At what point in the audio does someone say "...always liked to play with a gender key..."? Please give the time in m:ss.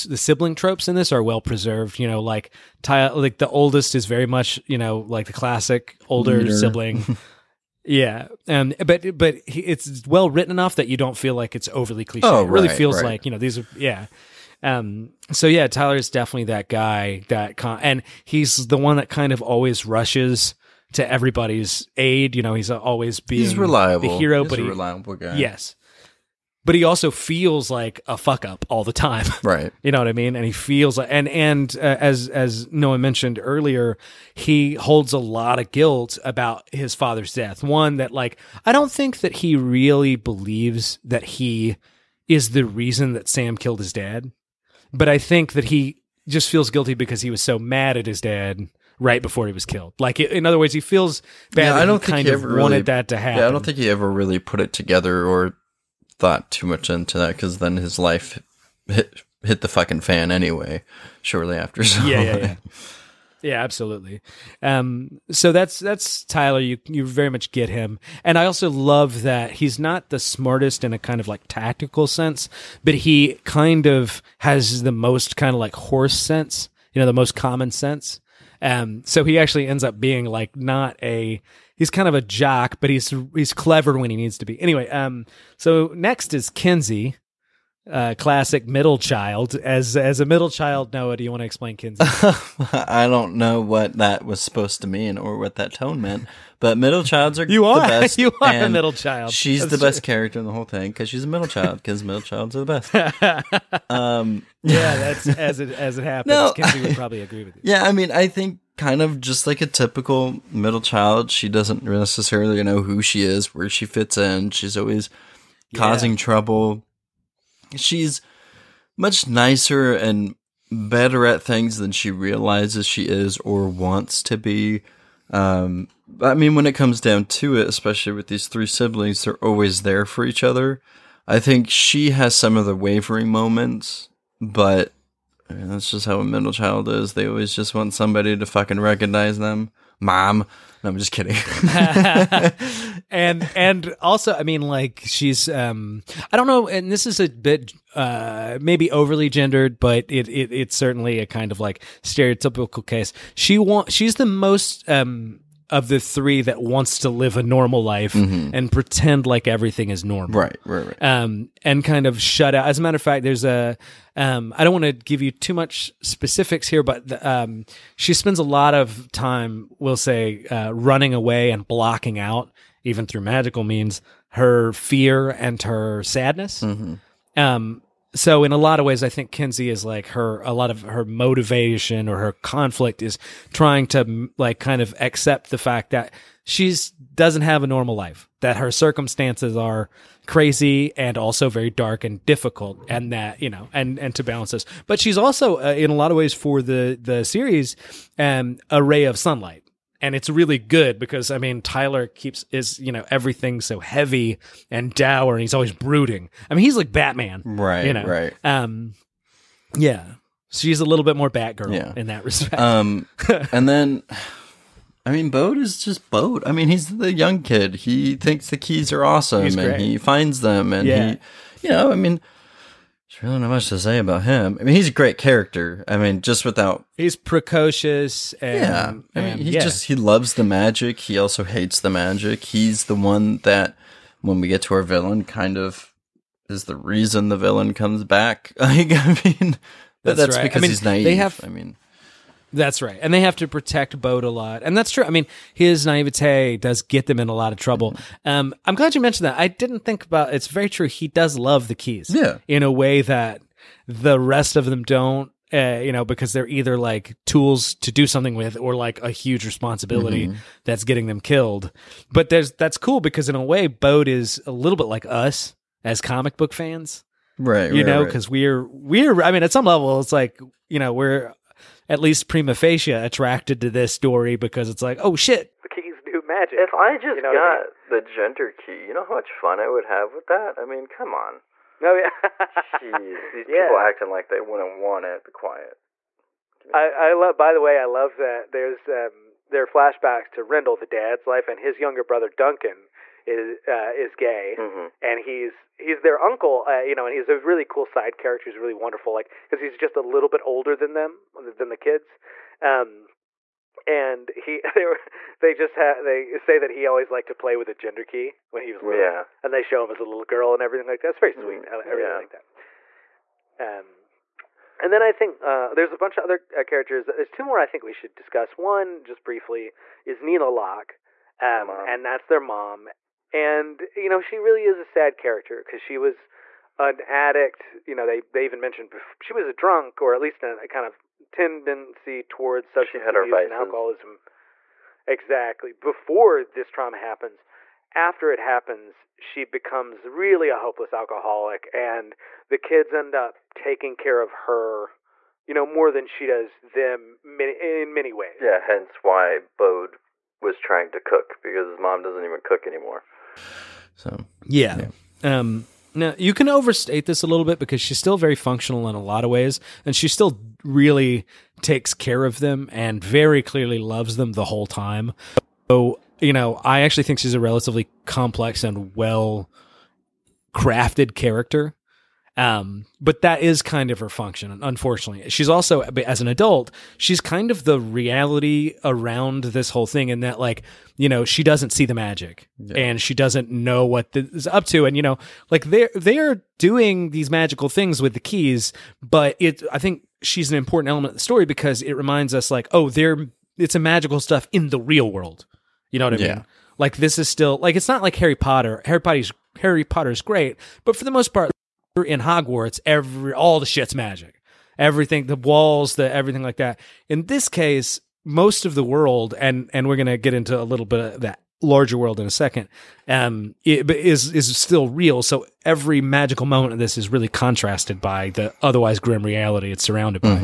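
5:06.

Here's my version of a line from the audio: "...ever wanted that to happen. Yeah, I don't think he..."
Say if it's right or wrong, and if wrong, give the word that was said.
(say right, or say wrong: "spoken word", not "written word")
right.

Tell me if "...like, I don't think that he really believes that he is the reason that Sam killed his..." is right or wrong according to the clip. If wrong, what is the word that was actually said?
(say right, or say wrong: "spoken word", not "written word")
right.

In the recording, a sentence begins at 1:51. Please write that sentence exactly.
She doesn't necessarily know who she is, where she fits in.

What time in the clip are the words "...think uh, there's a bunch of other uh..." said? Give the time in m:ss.
5:15.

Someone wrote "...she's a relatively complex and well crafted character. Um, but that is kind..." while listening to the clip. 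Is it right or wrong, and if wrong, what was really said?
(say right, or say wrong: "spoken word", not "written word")
right.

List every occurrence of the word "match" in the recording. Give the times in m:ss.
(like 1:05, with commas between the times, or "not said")
not said.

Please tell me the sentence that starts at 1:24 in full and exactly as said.
Anyway, um, so next is Kinsey, uh, classic middle child.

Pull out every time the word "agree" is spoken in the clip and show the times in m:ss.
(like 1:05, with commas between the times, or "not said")
1:47.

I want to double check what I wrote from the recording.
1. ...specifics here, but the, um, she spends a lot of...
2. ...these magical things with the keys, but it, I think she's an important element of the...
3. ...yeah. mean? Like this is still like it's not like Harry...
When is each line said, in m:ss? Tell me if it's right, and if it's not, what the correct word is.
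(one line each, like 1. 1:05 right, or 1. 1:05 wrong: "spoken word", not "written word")
1. 2:46 right
2. 6:27 right
3. 6:36 right.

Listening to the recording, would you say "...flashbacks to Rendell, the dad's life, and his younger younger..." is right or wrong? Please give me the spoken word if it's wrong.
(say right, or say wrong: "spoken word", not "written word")
wrong: "brother", not "younger".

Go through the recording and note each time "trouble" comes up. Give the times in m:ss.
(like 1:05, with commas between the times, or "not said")
1:56, 4:07.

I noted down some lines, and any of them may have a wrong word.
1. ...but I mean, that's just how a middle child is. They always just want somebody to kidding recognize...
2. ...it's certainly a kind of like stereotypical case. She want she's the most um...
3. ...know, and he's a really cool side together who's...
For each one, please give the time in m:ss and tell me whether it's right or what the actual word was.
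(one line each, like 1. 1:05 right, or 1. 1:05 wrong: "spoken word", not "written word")
1. 2:14 wrong: "fucking", not "kidding"
2. 2:30 right
3. 4:56 wrong: "character", not "together".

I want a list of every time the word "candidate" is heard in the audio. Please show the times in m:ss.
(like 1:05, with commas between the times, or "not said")
not said.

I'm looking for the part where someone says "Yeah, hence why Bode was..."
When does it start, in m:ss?
5:48.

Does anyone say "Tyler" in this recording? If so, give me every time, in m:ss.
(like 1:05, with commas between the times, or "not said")
0:15, 1:06, 3:21.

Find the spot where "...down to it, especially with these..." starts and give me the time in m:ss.
2:06.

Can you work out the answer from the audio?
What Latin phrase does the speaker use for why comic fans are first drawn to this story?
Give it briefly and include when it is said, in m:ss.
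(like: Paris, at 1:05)
prima facie, at 4:32.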